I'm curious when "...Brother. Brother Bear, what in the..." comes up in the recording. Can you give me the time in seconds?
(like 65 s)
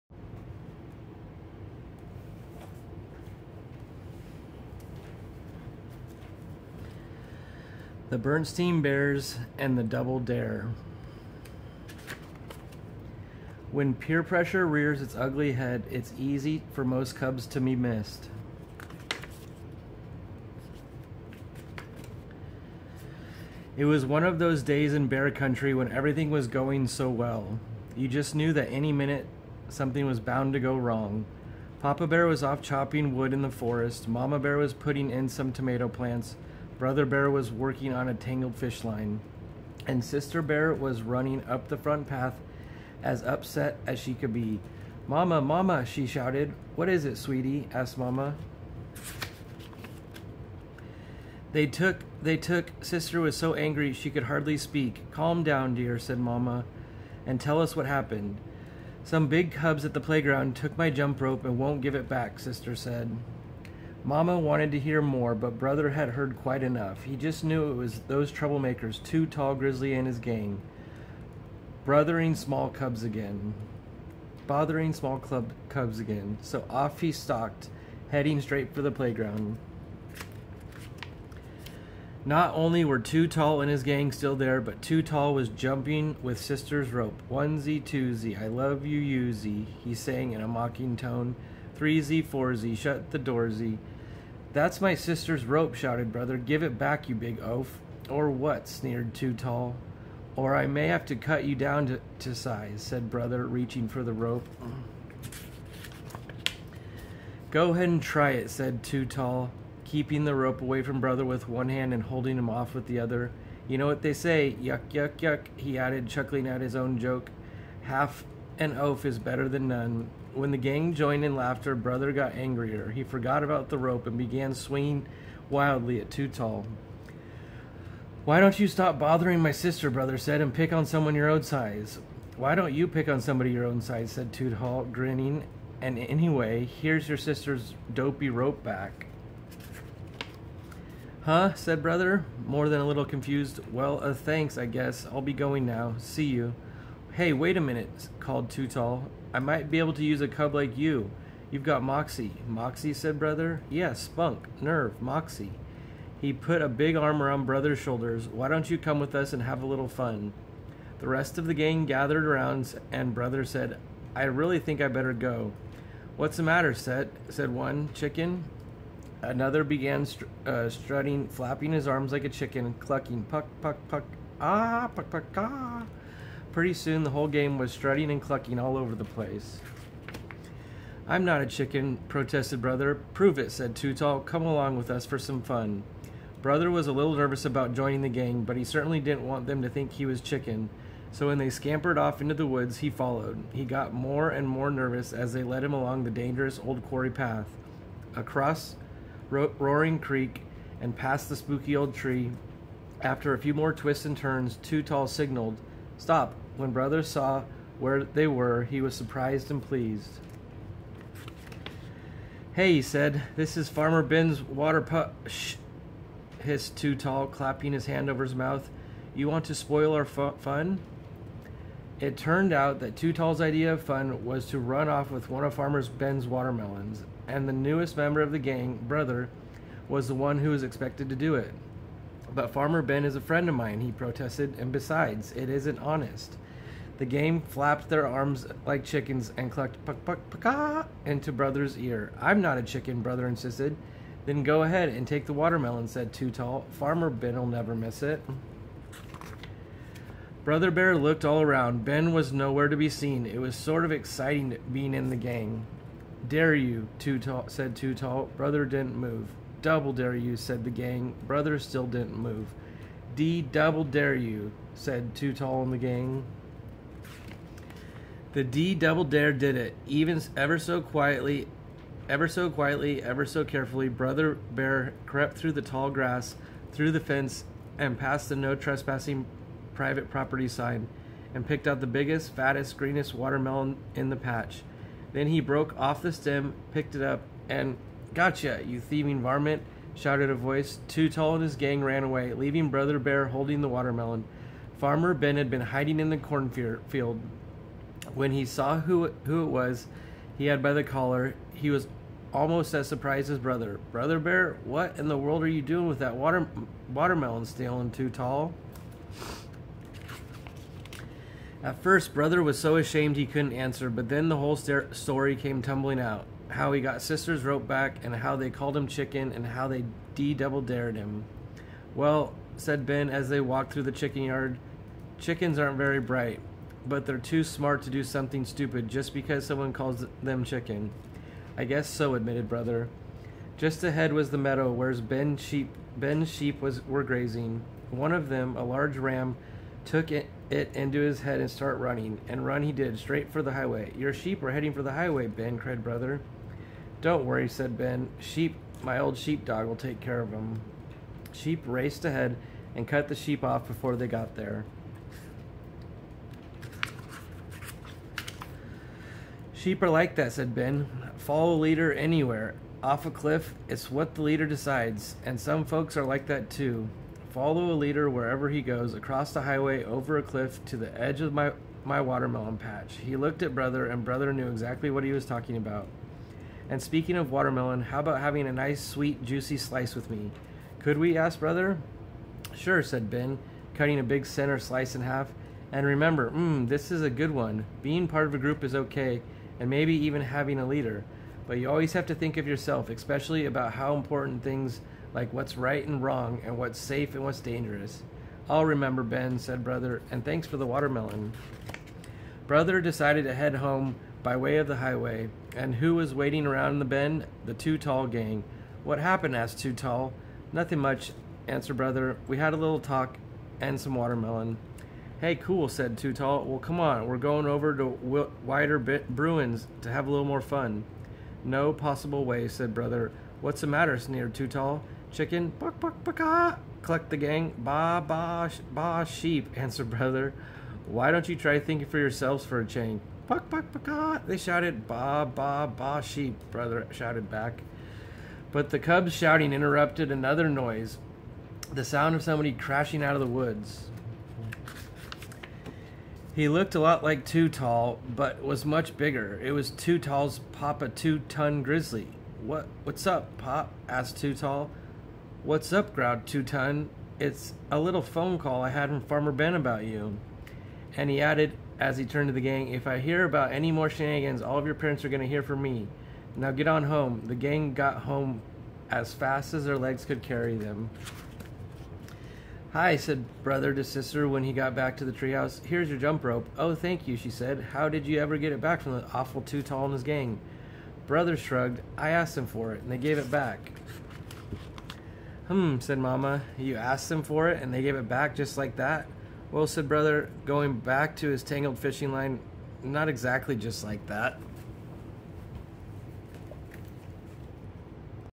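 303 s.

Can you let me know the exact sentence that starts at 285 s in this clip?
Then he broke off the stem, picked it up, and Gotcha, you thieving varmint, shouted a voice.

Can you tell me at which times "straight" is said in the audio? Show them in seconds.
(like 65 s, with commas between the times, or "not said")
78 s, 342 s.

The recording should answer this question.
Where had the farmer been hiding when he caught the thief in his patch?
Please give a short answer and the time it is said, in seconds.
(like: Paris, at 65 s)
In the cornfield, at 296 s.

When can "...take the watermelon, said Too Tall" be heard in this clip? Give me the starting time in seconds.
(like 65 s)
245 s.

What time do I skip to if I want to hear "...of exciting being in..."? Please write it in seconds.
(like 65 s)
253 s.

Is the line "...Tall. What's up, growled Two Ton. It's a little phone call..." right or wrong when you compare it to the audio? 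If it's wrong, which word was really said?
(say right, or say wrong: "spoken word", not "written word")
right.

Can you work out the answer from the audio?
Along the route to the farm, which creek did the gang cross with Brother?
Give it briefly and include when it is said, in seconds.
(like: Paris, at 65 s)
Roaring Creek, at 199 s.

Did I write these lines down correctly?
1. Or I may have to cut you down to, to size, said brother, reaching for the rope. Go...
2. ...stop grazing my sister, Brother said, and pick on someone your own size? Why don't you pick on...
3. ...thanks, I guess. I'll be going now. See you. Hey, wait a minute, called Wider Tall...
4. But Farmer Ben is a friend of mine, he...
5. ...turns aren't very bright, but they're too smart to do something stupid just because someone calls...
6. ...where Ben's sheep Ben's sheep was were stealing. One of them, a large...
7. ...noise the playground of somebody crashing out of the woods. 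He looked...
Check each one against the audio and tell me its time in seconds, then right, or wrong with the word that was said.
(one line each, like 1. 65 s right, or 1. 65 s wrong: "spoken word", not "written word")
1. 100 s right
2. 128 s wrong: "bothering", not "grazing"
3. 144 s wrong: "Too", not "Wider"
4. 232 s right
5. 325 s wrong: "chickens", not "turns"
6. 334 s wrong: "grazing", not "stealing"
7. 440 s wrong: "sound", not "playground".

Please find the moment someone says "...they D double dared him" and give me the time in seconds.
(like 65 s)
319 s.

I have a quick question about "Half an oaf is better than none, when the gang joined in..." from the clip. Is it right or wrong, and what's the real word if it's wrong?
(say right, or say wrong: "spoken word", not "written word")
right.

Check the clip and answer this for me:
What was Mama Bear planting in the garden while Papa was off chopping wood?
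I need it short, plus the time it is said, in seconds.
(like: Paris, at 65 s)
Tomato plants, at 35 s.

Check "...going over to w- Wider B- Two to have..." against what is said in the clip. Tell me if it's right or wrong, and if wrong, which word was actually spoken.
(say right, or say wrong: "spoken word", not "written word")
wrong: "Bruins", not "Two".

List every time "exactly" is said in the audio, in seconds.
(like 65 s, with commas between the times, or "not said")
374 s, 493 s.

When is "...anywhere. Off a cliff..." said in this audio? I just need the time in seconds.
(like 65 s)
361 s.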